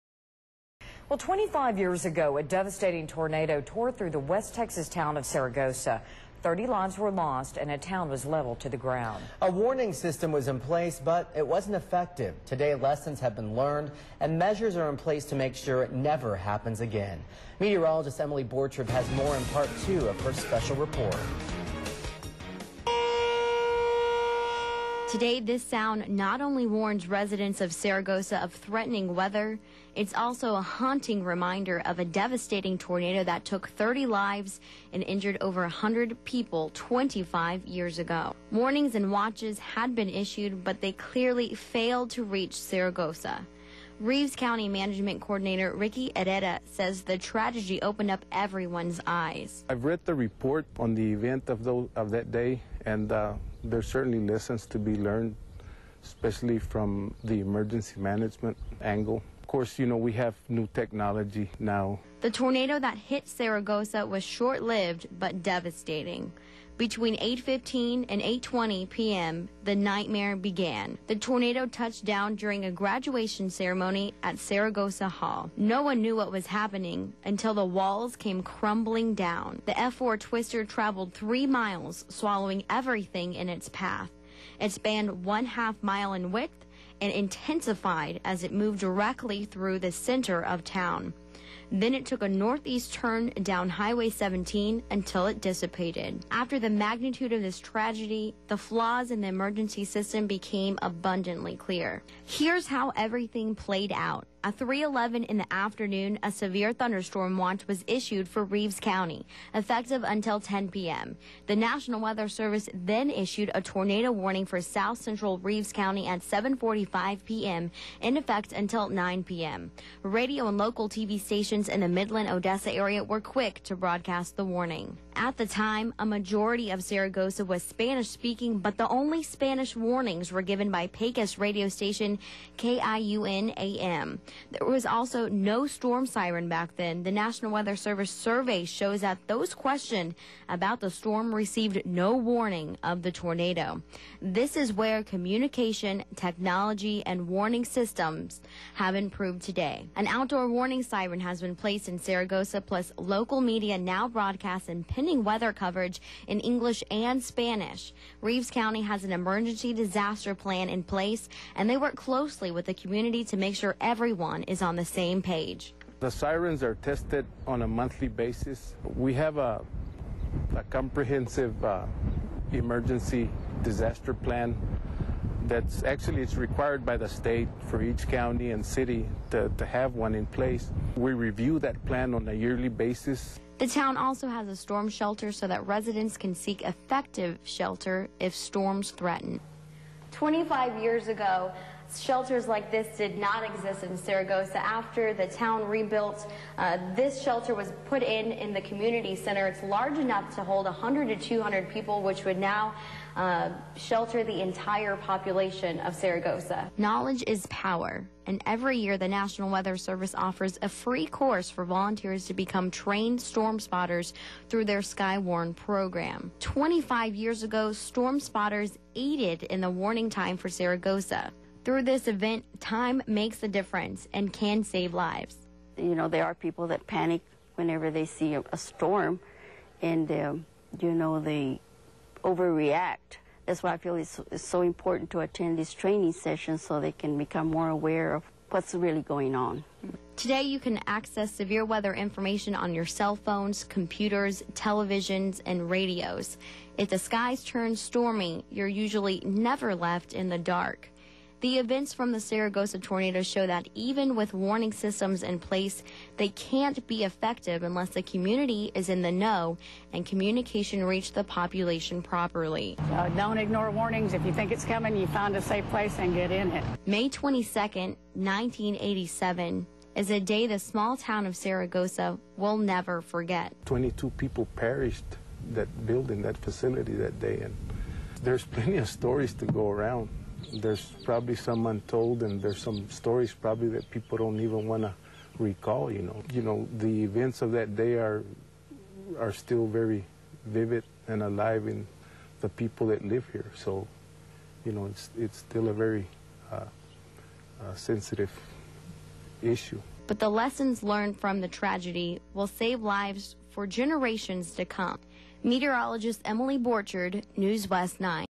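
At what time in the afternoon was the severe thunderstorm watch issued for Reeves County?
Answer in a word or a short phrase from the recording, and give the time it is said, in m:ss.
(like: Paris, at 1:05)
3:11, at 1:44.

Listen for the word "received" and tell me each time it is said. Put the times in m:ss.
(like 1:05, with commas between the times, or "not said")
2:21.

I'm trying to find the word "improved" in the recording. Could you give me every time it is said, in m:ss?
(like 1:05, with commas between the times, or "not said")
2:28.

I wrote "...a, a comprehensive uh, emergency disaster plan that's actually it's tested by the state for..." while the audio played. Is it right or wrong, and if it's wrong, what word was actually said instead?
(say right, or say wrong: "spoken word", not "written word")
wrong: "required", not "tested".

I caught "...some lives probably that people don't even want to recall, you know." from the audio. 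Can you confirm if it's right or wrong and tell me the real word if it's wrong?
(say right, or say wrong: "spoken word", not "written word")
wrong: "stories", not "lives".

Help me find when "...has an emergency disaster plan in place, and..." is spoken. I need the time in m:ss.
2:38.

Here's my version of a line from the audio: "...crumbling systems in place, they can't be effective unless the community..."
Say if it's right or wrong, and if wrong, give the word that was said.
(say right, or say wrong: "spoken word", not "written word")
wrong: "warning", not "crumbling".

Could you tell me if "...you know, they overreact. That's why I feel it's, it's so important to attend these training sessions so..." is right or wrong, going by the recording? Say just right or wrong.
right.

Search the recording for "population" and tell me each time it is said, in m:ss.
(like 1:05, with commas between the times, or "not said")
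3:24, 4:21.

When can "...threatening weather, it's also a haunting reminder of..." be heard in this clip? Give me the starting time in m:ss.
0:28.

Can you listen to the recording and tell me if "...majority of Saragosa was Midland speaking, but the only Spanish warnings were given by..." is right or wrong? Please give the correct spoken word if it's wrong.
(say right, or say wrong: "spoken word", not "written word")
wrong: "Spanish", not "Midland".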